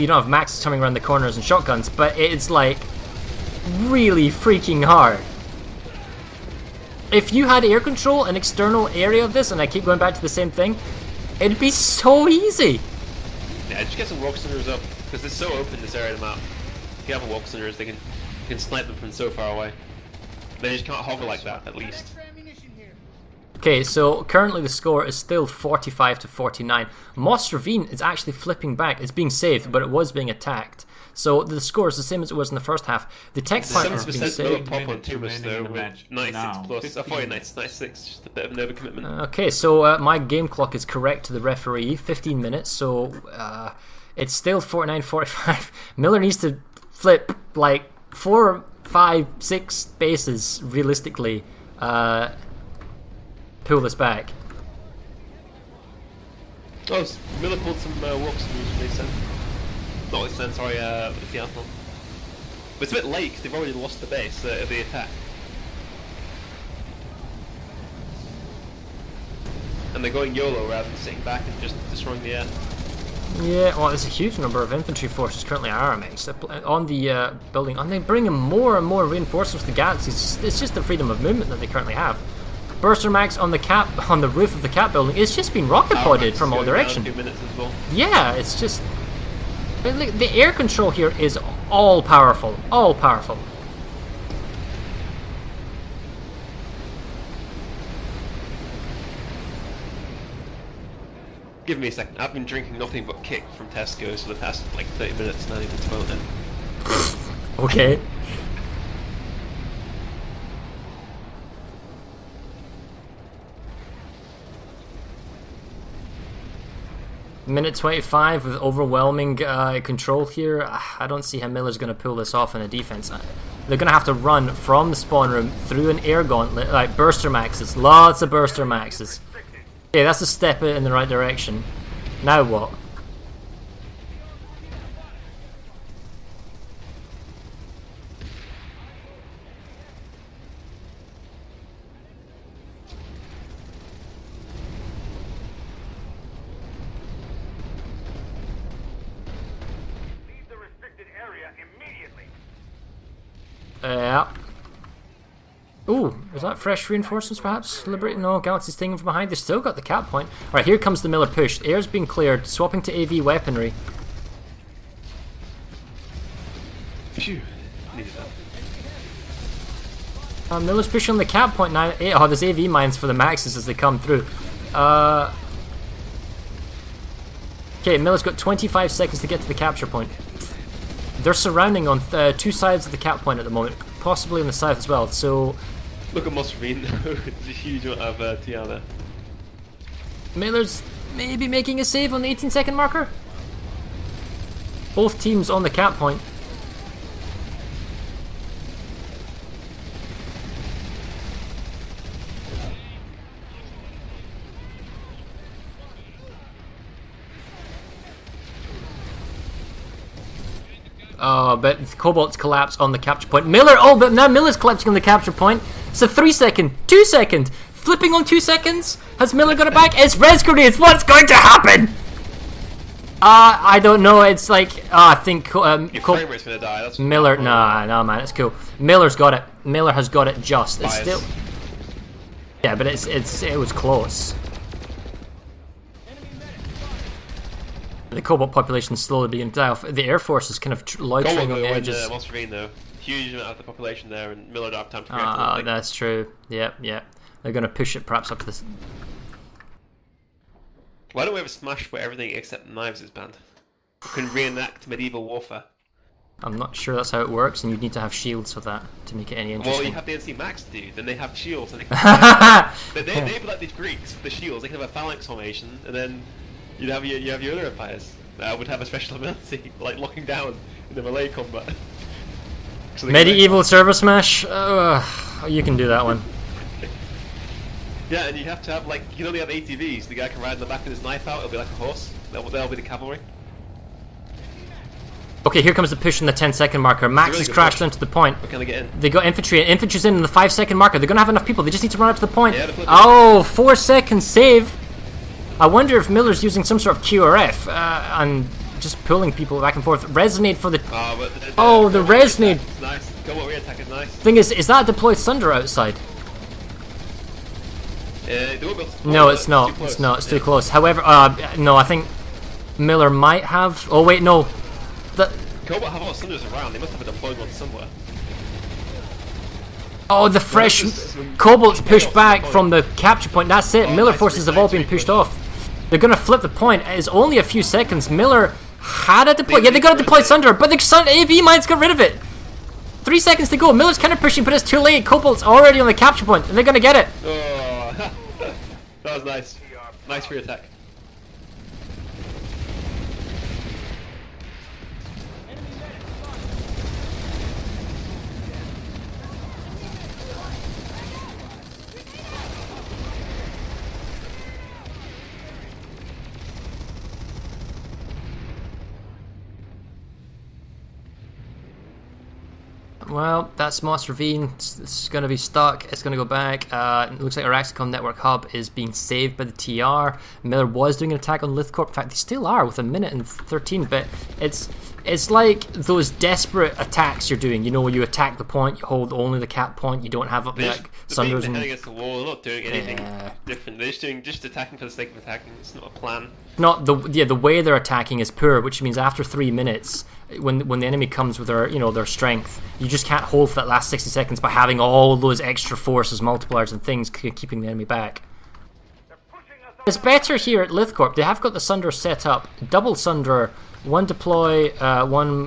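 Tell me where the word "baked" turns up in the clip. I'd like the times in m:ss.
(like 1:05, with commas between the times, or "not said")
not said.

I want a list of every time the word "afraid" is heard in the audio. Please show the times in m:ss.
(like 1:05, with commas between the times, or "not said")
not said.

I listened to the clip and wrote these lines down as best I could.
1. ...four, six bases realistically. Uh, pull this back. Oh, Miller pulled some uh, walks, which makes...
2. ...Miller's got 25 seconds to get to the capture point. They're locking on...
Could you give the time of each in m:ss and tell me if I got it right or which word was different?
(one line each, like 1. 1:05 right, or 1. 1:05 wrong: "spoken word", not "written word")
1. 0:48 wrong: "five", not "four"
2. 2:57 wrong: "surrounding", not "locking".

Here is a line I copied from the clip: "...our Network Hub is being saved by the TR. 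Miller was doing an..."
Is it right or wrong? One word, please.
right.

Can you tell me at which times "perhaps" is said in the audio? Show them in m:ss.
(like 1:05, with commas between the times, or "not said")
2:37, 4:08.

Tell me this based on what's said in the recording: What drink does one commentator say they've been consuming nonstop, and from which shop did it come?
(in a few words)
Kick from Tesco's.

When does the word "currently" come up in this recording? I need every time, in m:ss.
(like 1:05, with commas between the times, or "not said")
0:24, 1:15, 1:21.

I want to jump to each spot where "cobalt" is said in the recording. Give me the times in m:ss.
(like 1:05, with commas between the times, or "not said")
3:31, 3:58, 5:15, 5:21, 5:35.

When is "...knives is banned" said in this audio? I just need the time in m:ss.
4:12.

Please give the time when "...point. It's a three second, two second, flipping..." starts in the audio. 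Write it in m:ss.
3:35.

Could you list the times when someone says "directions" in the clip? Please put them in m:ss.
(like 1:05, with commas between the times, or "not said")
1:26, 2:11.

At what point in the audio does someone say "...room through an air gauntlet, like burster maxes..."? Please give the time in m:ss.
2:05.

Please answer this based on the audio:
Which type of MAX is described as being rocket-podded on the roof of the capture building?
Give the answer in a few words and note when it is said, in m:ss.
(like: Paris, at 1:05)
Burster Max, at 1:22.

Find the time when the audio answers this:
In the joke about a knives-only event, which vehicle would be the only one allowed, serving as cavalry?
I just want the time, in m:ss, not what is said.
4:39.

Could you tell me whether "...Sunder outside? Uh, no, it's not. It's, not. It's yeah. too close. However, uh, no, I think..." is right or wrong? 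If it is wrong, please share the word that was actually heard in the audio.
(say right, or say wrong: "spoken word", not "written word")
right.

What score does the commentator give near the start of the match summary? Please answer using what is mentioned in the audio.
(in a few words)
45 to 49.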